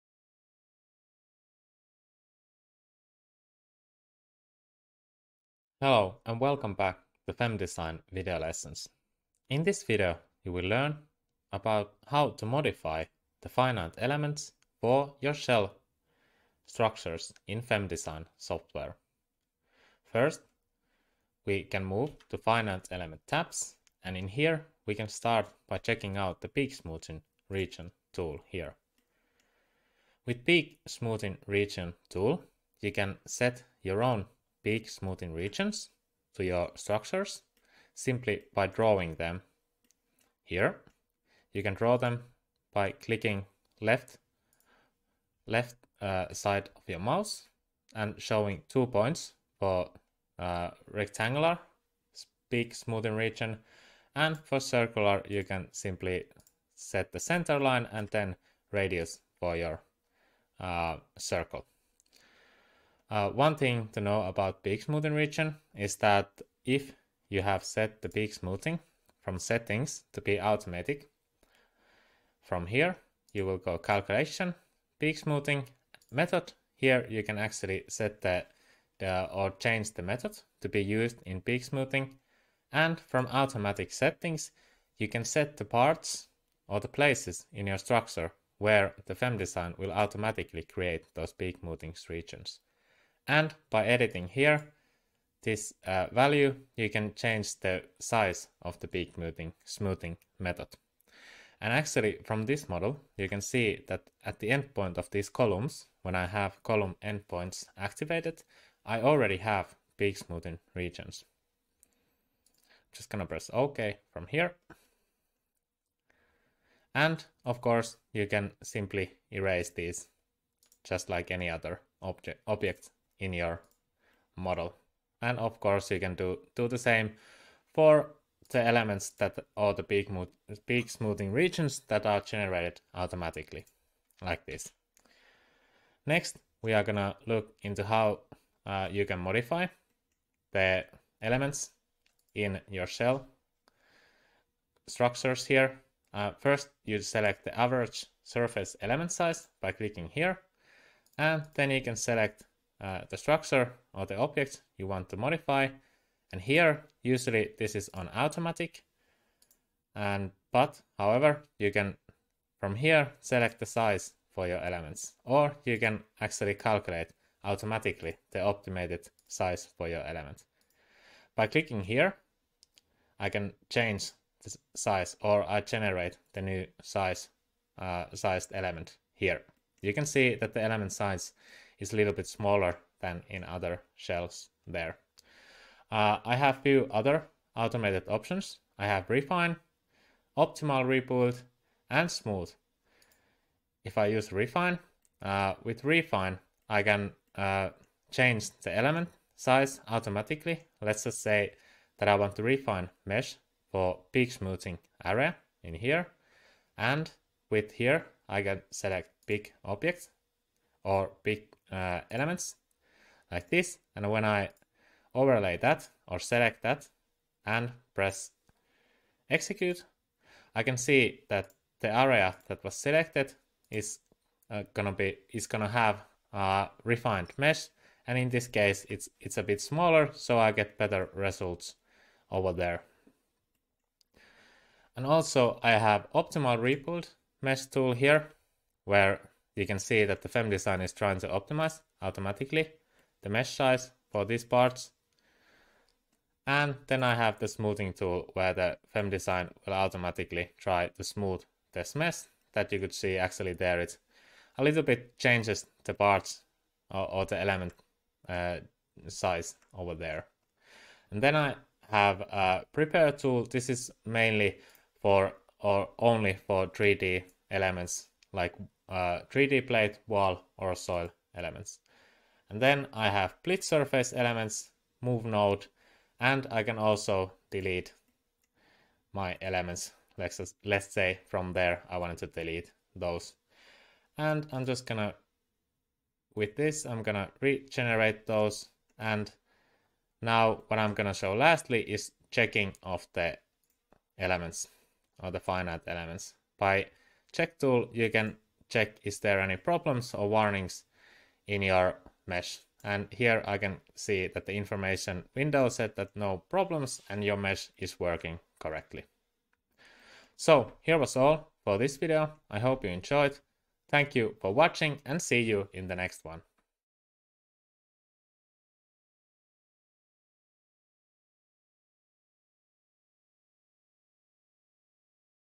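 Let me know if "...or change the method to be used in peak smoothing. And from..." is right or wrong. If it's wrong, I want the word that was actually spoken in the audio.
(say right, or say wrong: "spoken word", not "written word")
right.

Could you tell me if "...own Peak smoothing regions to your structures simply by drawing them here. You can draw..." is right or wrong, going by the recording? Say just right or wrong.
right.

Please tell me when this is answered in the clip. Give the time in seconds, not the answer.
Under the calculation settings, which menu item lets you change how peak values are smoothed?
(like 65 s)
74 s.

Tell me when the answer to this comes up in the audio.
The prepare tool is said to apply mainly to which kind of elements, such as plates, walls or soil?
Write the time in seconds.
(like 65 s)
266 s.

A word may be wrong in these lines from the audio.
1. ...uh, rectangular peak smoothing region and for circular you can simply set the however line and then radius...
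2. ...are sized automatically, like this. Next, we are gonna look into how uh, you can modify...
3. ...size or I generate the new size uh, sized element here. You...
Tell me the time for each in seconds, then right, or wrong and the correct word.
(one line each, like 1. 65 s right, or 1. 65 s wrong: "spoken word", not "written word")
1. 50 s wrong: "center", not "however"
2. 132 s wrong: "generated", not "sized"
3. 174 s right.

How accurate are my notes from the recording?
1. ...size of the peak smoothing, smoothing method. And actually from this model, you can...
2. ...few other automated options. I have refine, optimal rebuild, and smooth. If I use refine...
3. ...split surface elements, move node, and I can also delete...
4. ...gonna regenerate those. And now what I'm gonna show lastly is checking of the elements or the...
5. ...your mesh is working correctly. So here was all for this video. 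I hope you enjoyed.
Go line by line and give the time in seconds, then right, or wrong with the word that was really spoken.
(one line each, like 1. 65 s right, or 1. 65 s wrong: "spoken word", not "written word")
1. 97 s right
2. 186 s right
3. 273 s right
4. 287 s right
5. 307 s right.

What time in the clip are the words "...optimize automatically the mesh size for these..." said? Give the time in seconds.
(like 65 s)
241 s.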